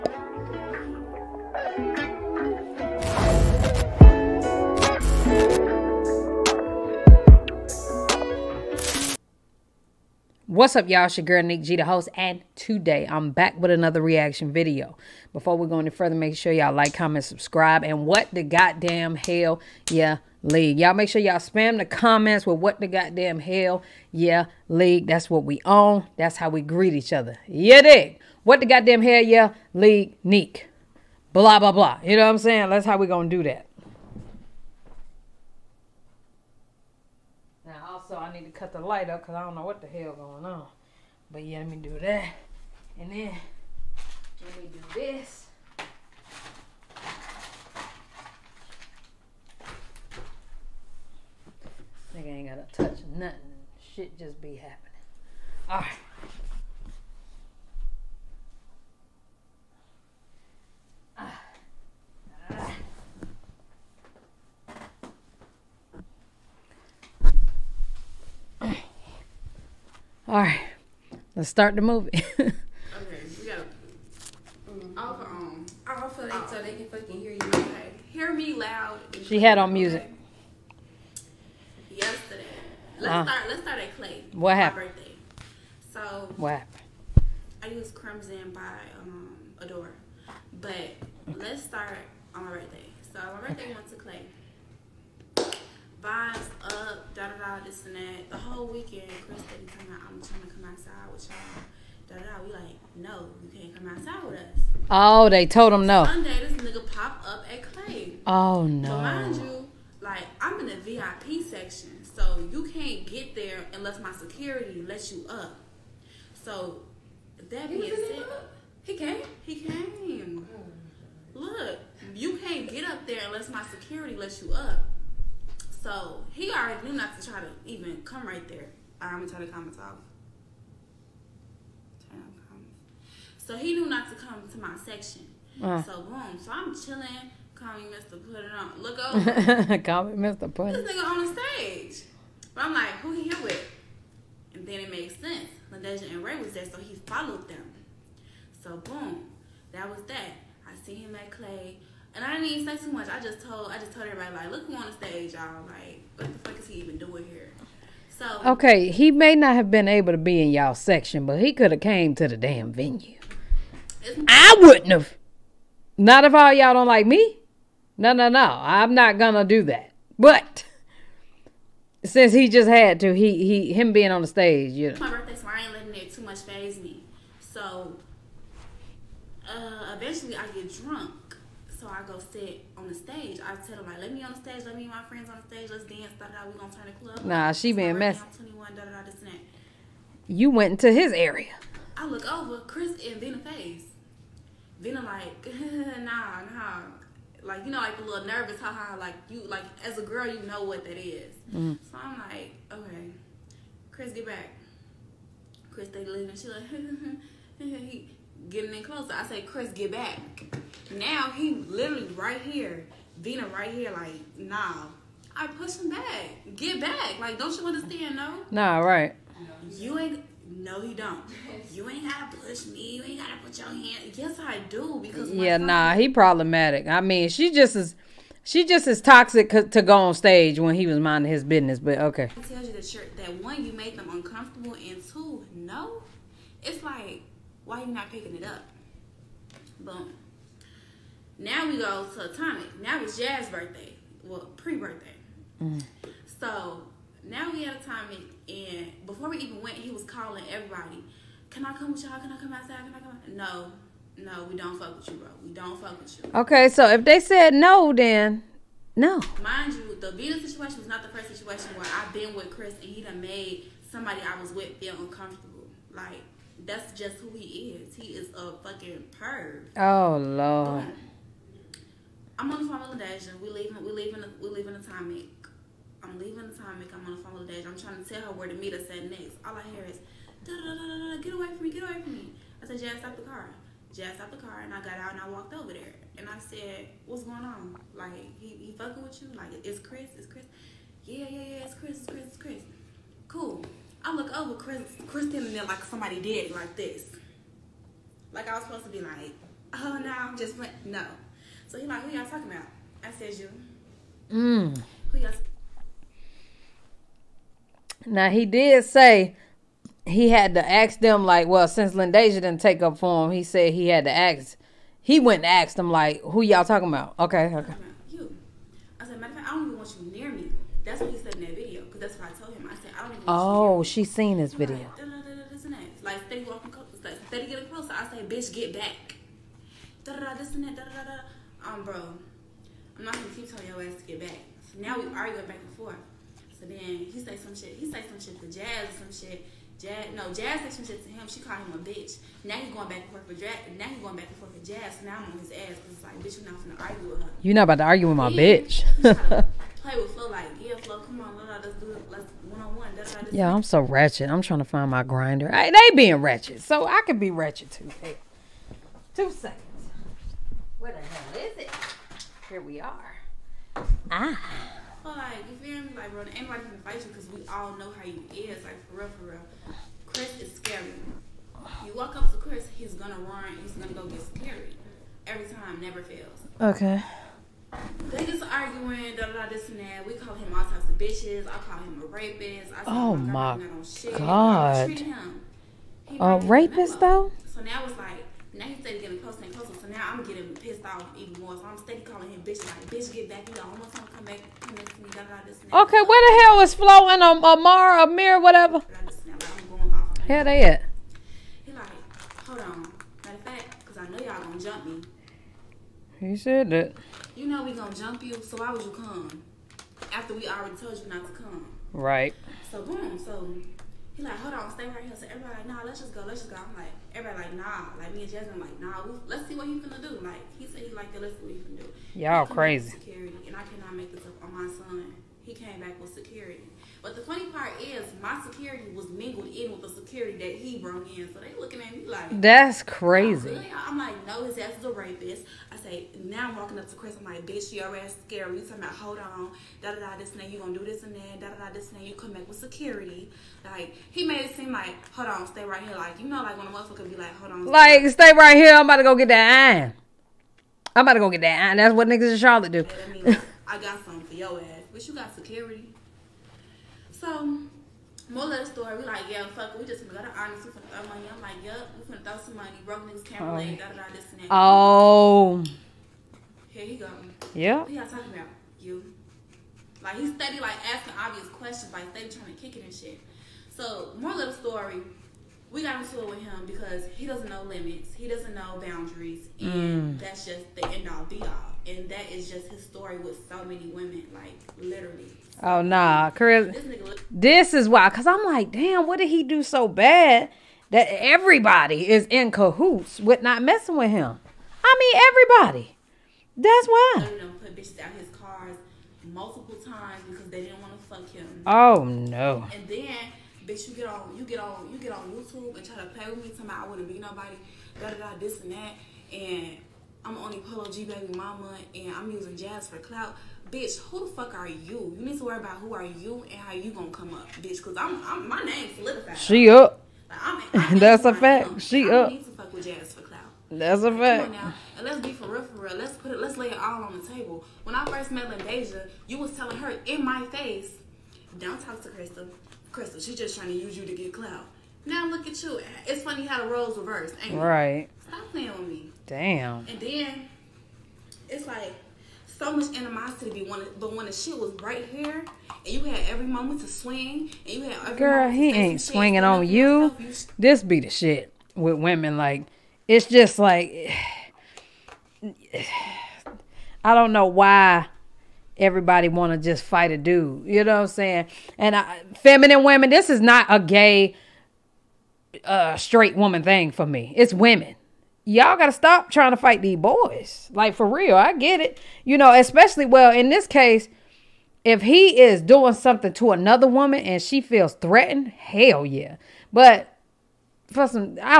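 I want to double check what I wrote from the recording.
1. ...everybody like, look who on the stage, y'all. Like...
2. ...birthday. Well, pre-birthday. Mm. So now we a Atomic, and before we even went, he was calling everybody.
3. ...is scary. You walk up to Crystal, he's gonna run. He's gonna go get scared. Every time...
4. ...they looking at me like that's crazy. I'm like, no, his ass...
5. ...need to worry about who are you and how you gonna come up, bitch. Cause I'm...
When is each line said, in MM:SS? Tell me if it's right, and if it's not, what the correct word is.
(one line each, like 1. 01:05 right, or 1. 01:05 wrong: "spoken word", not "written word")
1. 02:34 right
2. 04:03 right
3. 06:10 wrong: "Chris", not "Crystal"
4. 07:11 right
5. 08:35 right.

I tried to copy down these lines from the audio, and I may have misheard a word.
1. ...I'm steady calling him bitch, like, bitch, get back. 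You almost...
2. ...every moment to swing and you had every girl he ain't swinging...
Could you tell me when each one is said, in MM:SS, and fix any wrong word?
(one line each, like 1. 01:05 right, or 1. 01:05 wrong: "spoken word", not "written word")
1. 06:31 right
2. 09:06 right.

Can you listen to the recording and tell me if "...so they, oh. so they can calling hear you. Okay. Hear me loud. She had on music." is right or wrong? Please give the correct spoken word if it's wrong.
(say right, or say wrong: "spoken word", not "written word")
wrong: "fucking", not "calling".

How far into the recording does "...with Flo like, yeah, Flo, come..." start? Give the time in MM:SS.
05:49.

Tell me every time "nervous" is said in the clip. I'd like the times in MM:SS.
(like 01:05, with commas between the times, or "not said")
03:18.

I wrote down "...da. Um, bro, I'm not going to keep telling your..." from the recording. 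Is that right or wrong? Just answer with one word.
right.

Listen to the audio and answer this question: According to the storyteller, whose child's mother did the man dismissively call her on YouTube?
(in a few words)
Polo G.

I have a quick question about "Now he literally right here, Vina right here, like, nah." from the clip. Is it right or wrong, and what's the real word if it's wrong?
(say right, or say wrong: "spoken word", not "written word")
right.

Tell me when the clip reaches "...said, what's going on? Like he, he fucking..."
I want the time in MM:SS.
04:46.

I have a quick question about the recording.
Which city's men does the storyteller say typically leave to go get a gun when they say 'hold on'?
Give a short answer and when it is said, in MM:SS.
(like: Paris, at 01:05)
Charlotte, at 07:31.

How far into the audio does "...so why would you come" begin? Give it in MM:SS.
06:48.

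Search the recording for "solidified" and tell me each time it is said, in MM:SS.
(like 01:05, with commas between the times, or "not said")
08:38.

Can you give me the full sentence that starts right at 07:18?
You talking about hold on, da da da this and that.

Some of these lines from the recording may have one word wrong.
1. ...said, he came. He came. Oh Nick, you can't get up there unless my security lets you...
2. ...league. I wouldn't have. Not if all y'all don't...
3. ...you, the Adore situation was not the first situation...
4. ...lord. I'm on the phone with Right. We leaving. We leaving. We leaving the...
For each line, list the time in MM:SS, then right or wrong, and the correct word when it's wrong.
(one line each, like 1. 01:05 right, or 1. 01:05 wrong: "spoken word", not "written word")
1. 01:57 wrong: "Look", not "Nick"
2. 02:42 wrong: "venue", not "league"
3. 04:19 wrong: "Vita", not "Adore"
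4. 04:30 wrong: "Lyndeja", not "Right".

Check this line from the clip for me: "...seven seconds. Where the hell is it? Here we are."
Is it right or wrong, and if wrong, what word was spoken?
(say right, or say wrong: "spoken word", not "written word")
wrong: "two", not "seven".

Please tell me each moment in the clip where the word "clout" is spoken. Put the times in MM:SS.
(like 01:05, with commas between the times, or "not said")
08:32, 08:43, 08:54.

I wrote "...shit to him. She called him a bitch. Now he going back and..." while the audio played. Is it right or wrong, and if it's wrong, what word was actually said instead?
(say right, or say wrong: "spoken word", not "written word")
right.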